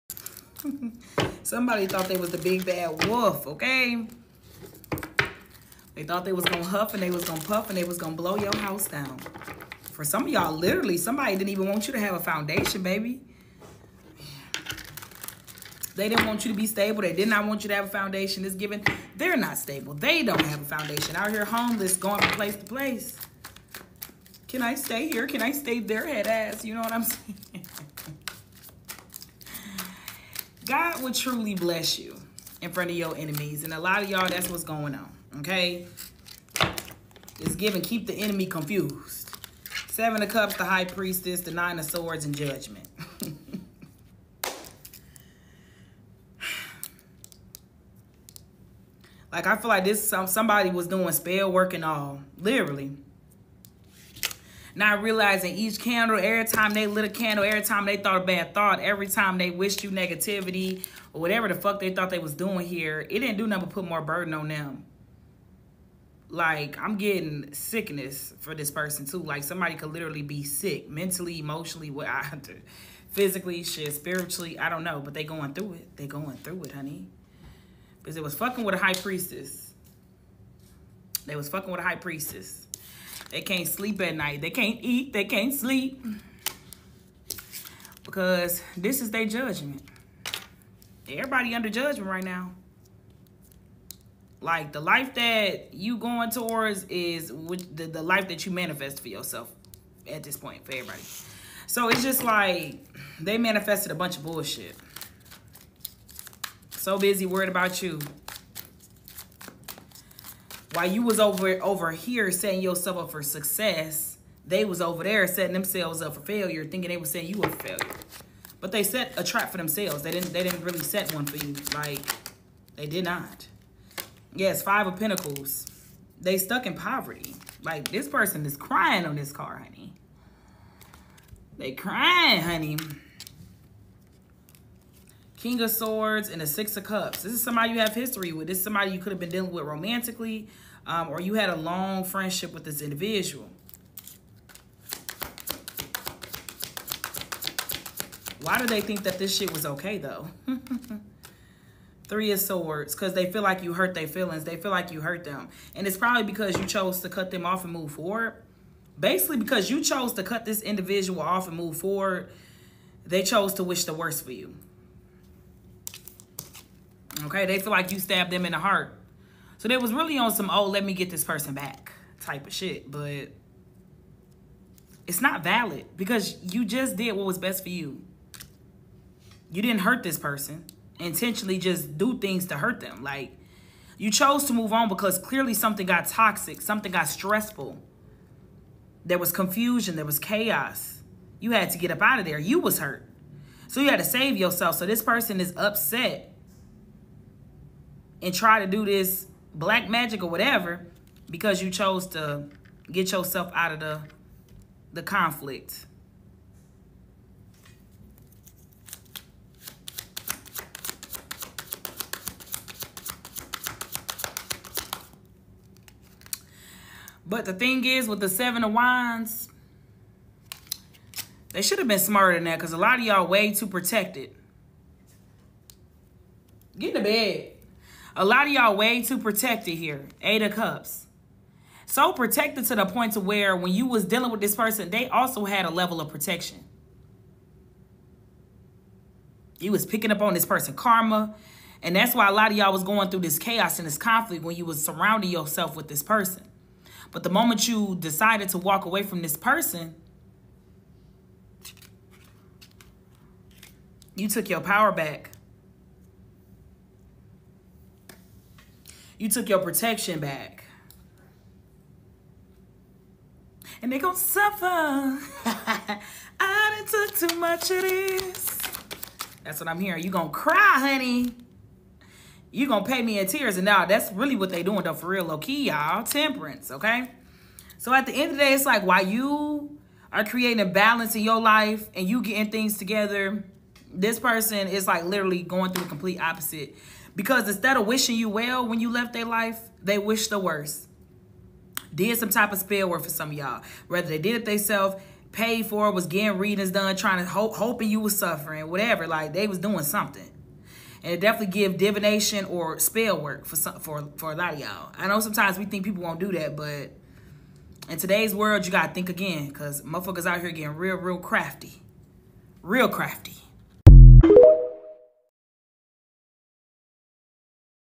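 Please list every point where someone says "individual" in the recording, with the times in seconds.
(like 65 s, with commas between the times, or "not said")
142 s, 160 s.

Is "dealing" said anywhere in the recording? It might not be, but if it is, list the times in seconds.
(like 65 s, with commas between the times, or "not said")
139 s, 234 s.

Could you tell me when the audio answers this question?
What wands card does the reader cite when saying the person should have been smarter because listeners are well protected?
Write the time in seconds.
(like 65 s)
218 s.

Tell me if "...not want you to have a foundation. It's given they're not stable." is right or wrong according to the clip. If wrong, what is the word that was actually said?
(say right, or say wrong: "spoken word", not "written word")
right.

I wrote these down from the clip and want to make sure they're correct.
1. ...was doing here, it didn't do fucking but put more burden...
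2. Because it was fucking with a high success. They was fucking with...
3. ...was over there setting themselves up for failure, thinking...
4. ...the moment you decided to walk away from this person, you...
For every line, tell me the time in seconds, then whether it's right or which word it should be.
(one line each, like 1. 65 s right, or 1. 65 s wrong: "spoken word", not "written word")
1. 62 s wrong: "nothing", not "fucking"
2. 78 s wrong: "priestess", not "success"
3. 114 s right
4. 247 s right.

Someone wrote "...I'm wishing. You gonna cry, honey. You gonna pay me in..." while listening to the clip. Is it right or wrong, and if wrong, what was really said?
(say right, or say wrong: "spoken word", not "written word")
wrong: "hearing", not "wishing".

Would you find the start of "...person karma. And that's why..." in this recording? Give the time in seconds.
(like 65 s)
240 s.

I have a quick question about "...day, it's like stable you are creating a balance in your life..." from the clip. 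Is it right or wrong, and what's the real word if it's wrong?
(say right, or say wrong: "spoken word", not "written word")
wrong: "while", not "stable".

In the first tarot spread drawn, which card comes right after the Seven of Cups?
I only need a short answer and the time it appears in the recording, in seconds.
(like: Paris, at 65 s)
The High Priestess, at 40 s.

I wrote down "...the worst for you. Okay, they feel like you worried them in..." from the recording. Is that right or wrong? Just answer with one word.
wrong.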